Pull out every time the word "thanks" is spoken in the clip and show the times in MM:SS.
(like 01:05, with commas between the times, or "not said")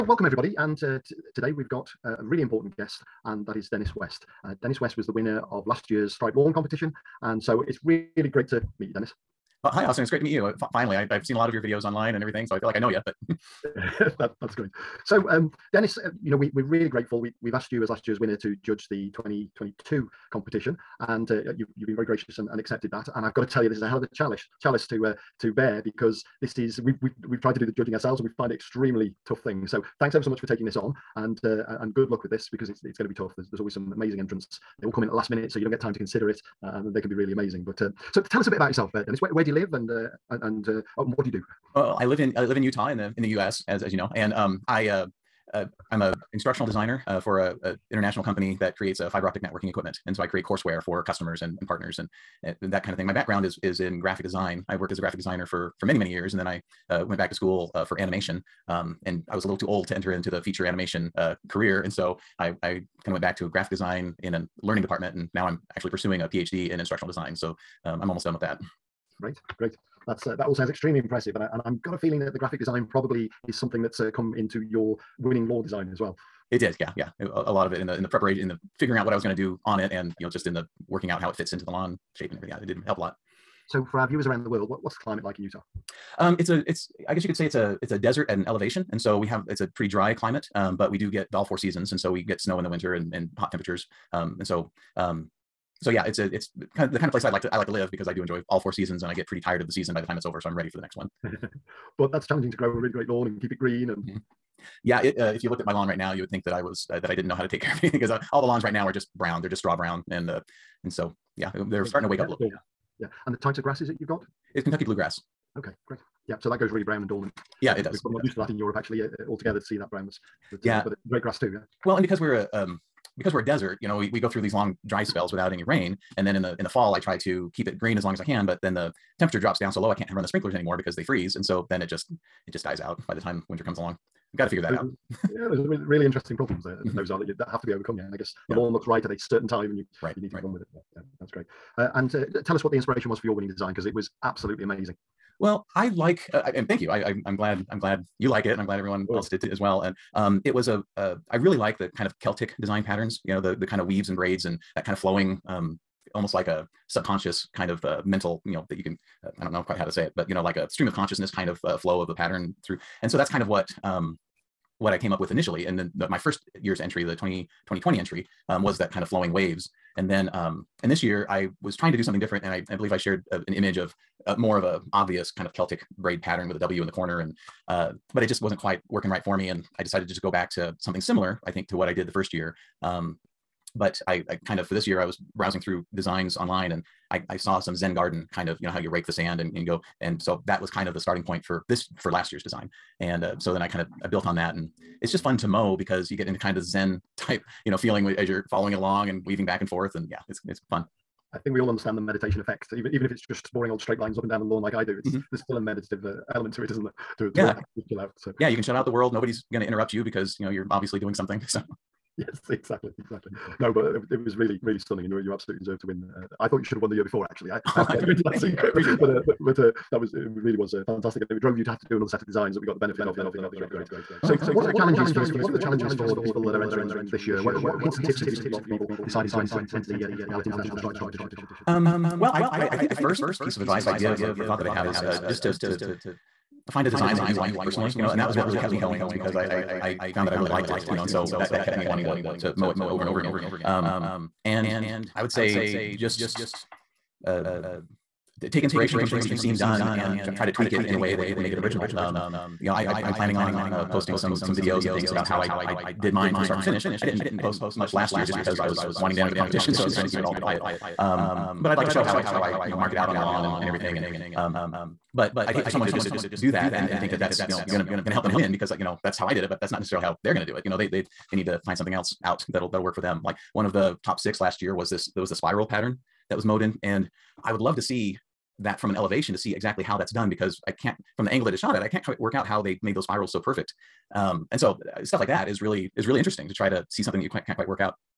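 00:30, 02:26.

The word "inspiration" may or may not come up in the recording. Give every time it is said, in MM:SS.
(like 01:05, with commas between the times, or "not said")
02:22, 04:08.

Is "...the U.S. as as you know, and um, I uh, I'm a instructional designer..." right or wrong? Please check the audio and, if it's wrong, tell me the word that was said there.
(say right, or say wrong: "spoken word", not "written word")
right.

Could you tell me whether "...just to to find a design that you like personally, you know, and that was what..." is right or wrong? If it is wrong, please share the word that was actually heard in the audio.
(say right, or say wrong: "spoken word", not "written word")
right.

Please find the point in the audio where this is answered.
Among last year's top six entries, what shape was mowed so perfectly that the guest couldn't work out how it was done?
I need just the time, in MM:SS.
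04:35.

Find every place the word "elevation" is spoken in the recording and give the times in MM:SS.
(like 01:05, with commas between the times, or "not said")
01:28, 04:38.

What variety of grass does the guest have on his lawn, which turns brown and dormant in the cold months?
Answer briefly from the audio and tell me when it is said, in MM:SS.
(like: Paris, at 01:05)
Kentucky bluegrass, at 01:54.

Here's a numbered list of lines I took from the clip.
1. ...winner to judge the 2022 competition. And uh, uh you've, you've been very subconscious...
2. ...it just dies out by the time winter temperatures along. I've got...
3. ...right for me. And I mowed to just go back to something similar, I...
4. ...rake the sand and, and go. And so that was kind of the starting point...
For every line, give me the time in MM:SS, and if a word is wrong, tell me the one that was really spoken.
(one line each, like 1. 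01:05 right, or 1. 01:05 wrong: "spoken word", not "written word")
1. 00:18 wrong: "gracious", not "subconscious"
2. 02:12 wrong: "comes", not "temperatures"
3. 02:59 wrong: "decided", not "mowed"
4. 03:08 right.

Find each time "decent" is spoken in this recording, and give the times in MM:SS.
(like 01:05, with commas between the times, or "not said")
not said.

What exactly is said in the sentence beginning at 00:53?
My background is is in graphic design.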